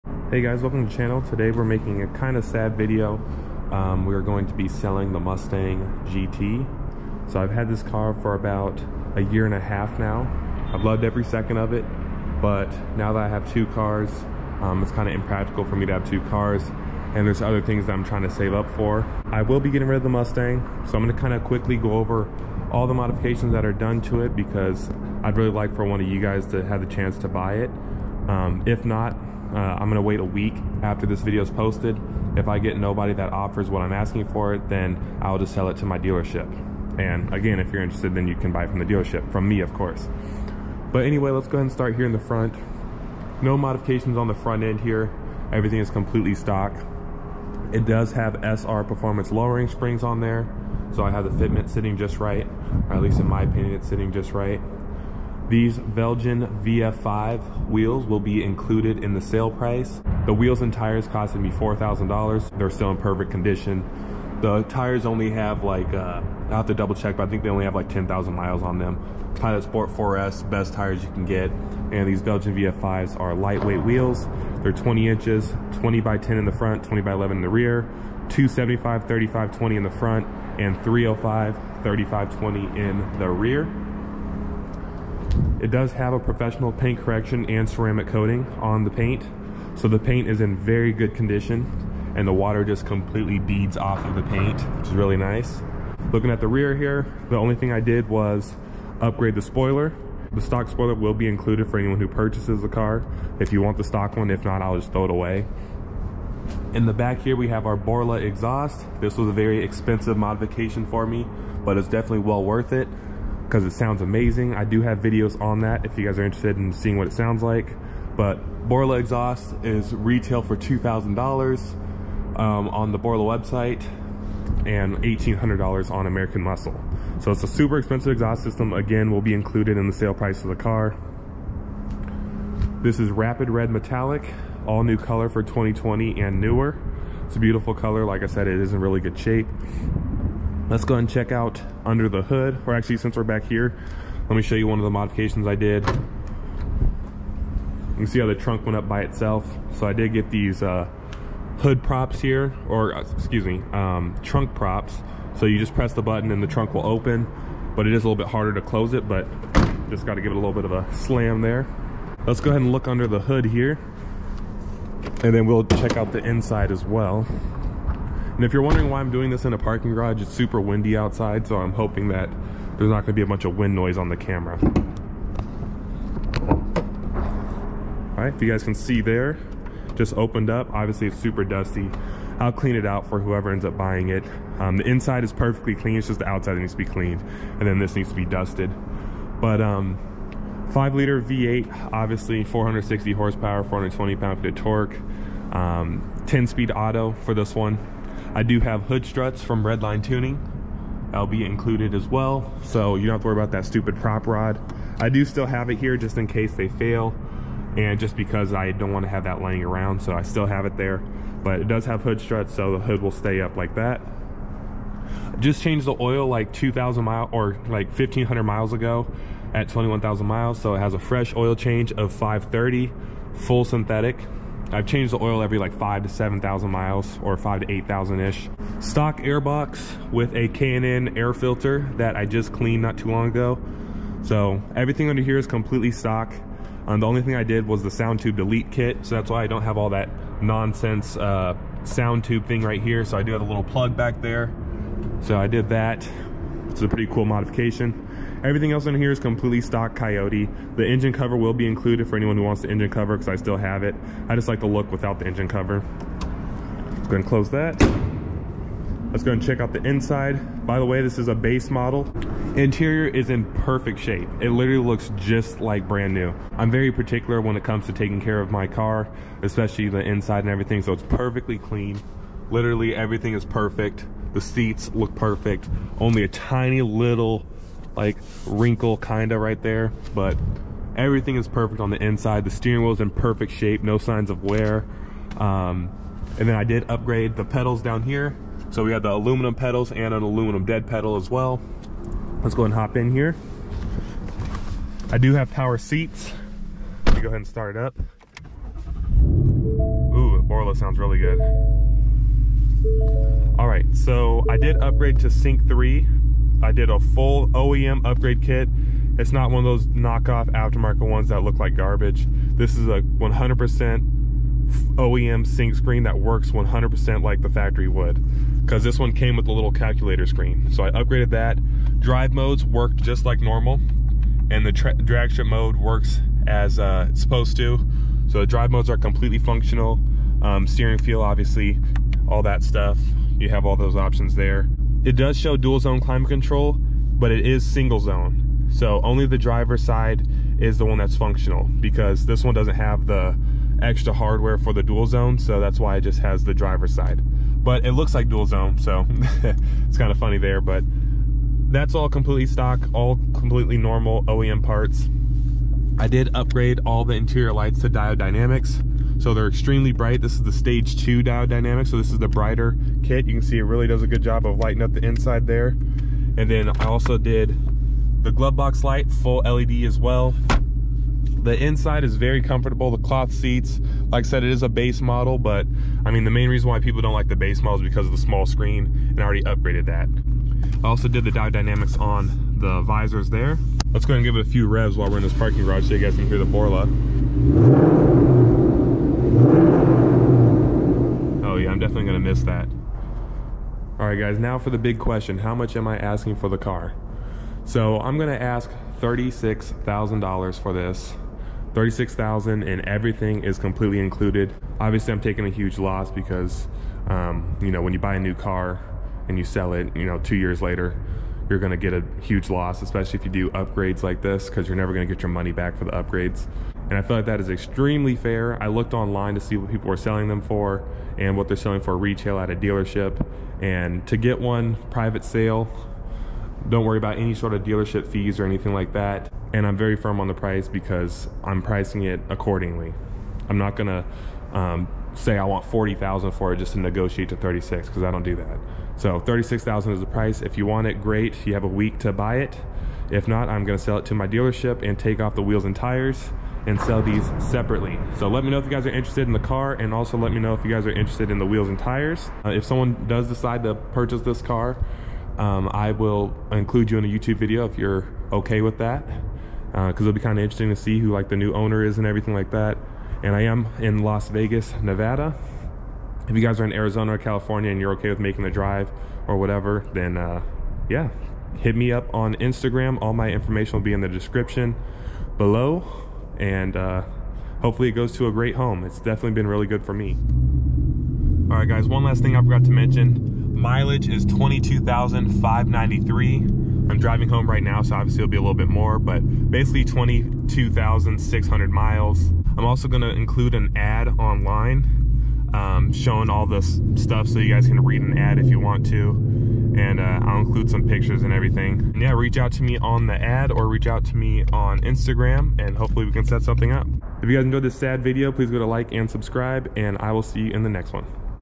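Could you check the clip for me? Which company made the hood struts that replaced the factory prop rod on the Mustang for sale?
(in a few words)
Redline Tuning.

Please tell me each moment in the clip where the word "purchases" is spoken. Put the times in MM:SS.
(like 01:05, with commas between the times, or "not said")
01:42, 07:33.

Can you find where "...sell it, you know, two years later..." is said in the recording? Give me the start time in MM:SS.
06:49.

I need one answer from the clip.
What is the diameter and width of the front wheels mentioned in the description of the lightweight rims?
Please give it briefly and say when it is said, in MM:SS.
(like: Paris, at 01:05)
20 by 10, at 01:15.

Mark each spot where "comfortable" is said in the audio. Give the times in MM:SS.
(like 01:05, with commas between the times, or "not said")
06:12.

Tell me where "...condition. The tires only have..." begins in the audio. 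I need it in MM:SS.
01:03.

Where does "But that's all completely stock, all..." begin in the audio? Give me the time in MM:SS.
05:50.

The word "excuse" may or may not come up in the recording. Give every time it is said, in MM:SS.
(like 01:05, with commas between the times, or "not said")
02:33.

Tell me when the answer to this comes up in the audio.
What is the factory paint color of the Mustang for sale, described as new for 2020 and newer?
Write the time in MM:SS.
02:13.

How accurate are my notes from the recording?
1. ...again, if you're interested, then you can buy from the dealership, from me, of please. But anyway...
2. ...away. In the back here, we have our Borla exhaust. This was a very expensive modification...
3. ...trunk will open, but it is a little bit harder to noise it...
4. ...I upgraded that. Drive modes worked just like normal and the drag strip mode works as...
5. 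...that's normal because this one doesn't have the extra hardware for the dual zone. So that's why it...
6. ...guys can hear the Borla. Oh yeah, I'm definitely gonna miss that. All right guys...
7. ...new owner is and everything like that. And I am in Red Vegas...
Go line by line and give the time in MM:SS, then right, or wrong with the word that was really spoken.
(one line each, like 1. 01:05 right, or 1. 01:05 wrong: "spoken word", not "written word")
1. 00:37 wrong: "course", not "please"
2. 01:45 right
3. 02:36 wrong: "close", not "noise"
4. 05:20 right
5. 05:40 wrong: "functional", not "normal"
6. 06:25 right
7. 07:41 wrong: "Las", not "Red".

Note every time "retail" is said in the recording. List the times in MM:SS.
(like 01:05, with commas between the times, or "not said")
01:59, 07:01.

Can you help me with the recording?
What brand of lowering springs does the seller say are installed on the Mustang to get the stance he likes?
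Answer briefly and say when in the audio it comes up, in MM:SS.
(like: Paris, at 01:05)
SR performance, at 00:48.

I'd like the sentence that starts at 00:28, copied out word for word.
Um, if not, uh, I'm going to wait a week after this video is posted.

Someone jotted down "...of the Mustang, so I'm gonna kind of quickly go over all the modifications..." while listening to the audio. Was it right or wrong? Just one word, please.
right.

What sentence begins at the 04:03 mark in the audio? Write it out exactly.
So I do have a little plug back there.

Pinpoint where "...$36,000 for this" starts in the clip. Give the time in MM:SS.
06:38.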